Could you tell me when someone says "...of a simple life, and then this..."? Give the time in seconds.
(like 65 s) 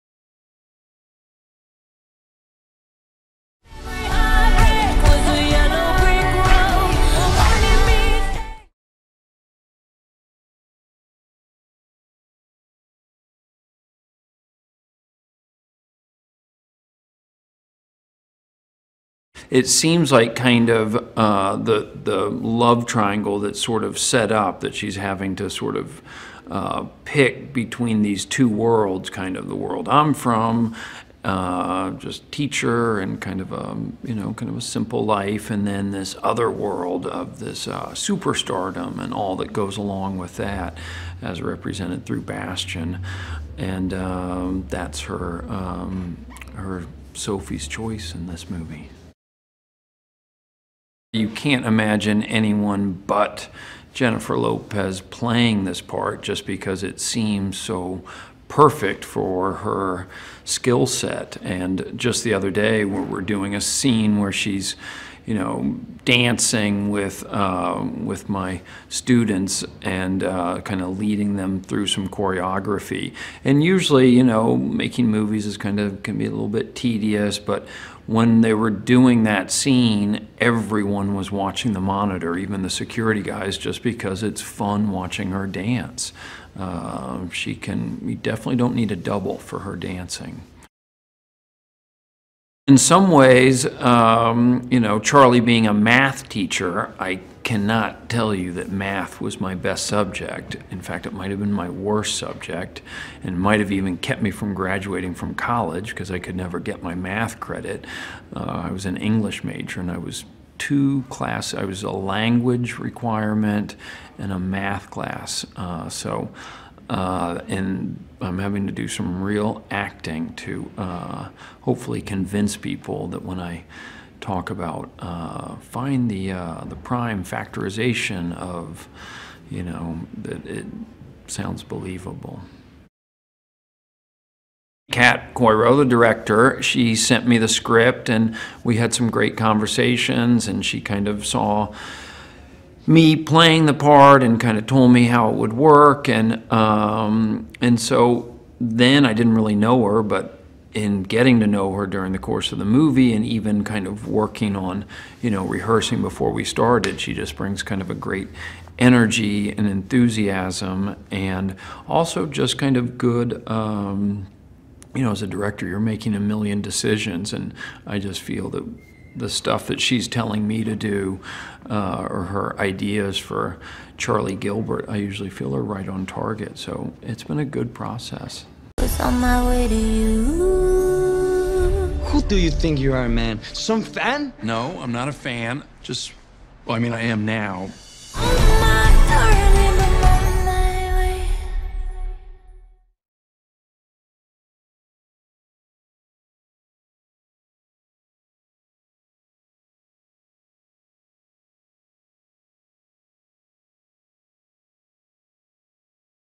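34 s.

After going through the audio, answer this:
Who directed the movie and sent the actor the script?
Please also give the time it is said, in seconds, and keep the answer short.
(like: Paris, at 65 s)
Kat Coiro, at 134 s.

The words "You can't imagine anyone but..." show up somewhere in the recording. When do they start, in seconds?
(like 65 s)
51 s.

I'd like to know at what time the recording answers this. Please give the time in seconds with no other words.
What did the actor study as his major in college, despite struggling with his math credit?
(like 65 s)
108 s.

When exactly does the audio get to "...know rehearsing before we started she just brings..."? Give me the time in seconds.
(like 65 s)
155 s.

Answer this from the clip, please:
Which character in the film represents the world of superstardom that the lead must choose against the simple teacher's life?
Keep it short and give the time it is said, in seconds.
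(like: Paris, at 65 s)
Bastian, at 42 s.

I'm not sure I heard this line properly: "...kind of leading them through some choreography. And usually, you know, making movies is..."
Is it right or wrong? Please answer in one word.
right.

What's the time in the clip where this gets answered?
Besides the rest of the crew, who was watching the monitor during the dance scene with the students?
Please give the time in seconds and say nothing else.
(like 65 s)
82 s.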